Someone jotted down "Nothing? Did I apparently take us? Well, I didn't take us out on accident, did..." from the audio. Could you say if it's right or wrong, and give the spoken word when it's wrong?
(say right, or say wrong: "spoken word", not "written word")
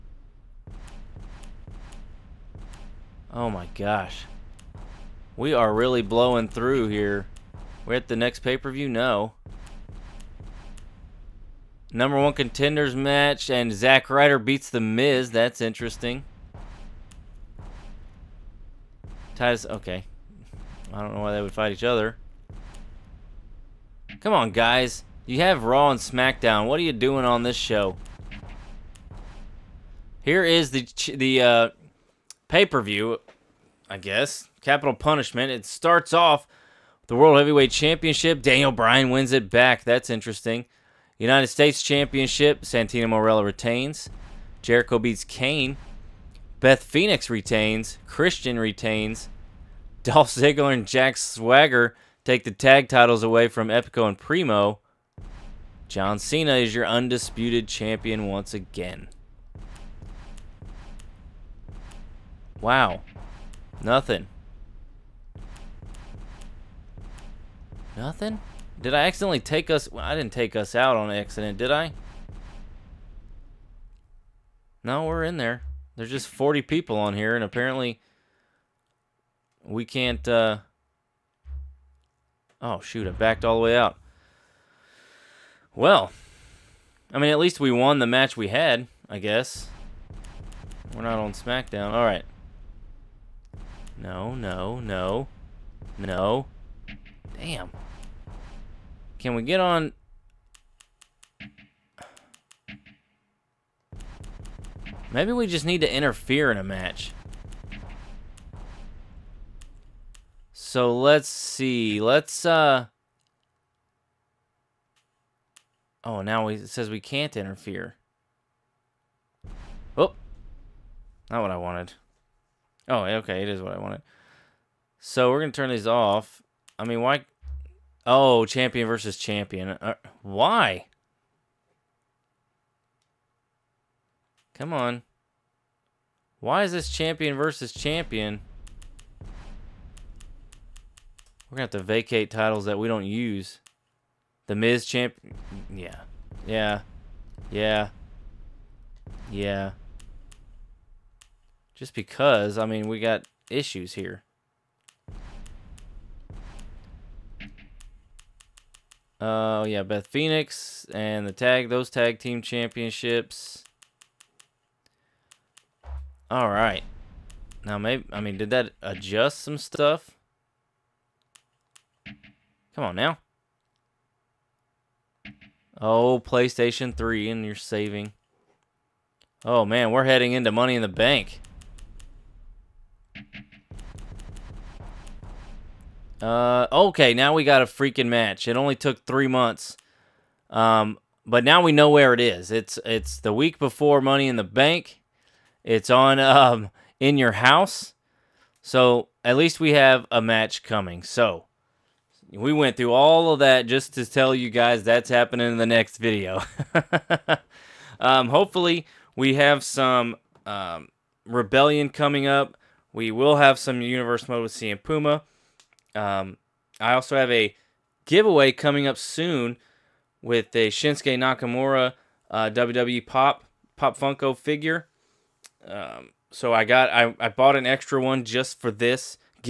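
wrong: "accidentally", not "apparently".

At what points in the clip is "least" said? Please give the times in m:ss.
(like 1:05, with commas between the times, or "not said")
1:27, 3:19.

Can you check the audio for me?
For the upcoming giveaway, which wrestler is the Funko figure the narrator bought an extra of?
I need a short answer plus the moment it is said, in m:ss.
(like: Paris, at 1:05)
Shinsuke Nakamura, at 3:40.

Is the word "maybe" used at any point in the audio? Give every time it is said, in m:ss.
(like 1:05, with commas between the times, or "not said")
1:45, 2:47.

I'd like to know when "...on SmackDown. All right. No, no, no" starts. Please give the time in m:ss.
1:31.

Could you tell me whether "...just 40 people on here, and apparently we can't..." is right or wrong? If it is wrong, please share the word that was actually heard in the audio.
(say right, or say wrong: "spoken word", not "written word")
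right.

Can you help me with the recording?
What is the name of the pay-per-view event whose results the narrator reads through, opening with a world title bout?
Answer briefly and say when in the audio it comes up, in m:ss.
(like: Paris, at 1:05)
Capital Punishment, at 0:34.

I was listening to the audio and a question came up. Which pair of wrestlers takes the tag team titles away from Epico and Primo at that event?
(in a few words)
Dolph Ziggler and Jack Swagger.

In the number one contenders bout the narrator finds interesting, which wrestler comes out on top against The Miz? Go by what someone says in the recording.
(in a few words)
Zack Ryder.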